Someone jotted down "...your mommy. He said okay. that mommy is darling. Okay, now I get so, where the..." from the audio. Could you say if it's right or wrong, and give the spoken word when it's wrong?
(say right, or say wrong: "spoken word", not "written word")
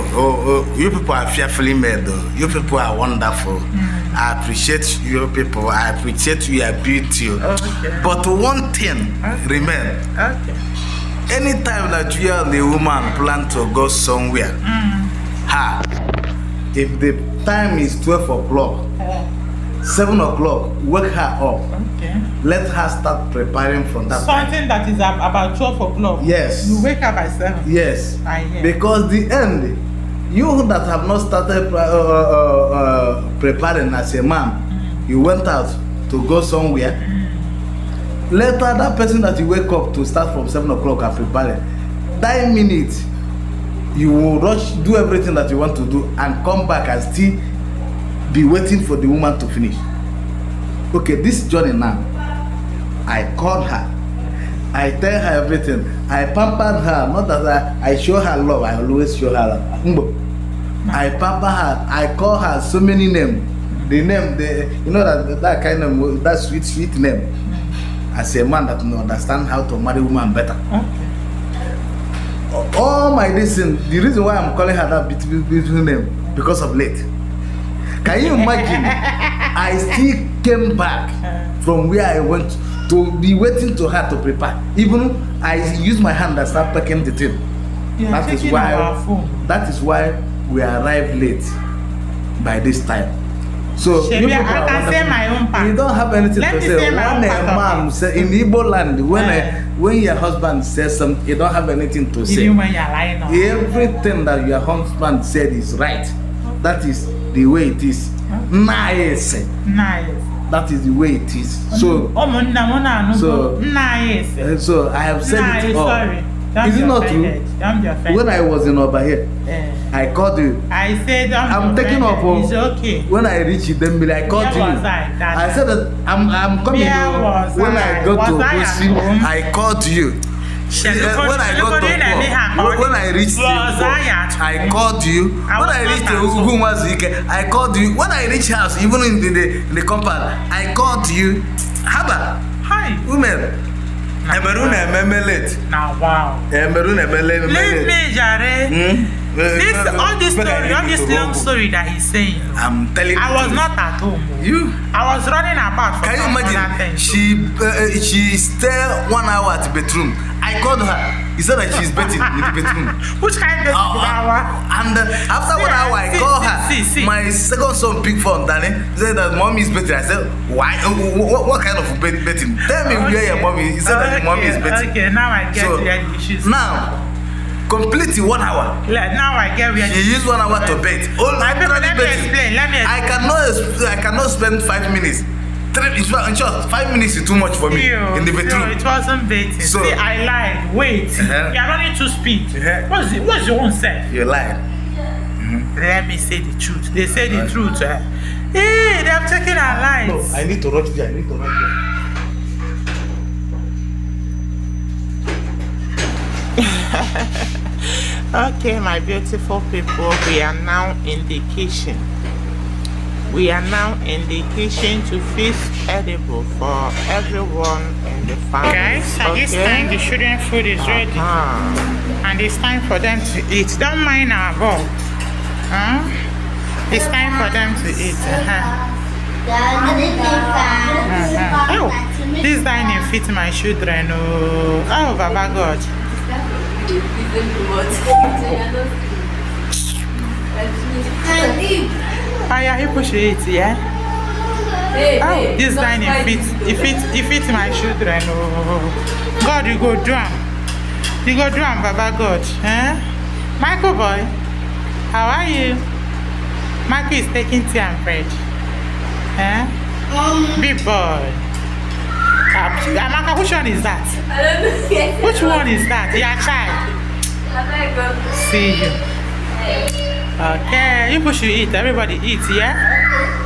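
wrong: "betting", not "darling".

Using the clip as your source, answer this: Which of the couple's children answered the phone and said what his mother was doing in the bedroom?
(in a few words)
second son.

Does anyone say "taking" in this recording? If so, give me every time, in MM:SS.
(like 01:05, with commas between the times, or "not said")
02:01, 04:17.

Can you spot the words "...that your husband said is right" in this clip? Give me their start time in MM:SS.
01:44.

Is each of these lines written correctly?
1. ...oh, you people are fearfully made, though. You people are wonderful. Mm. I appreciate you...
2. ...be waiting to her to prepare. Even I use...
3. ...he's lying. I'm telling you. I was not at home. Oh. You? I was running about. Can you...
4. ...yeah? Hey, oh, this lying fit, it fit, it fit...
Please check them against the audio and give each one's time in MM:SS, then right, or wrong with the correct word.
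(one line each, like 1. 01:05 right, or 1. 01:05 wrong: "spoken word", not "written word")
1. 00:00 right
2. 01:23 right
3. 02:31 wrong: "saying", not "lying"
4. 04:03 wrong: "dining", not "lying".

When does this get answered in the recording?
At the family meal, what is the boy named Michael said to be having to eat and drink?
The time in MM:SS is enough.
04:17.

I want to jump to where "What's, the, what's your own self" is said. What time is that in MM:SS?
03:12.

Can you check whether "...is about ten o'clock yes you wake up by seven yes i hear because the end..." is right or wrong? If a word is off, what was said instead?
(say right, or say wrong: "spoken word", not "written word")
wrong: "twelve", not "ten".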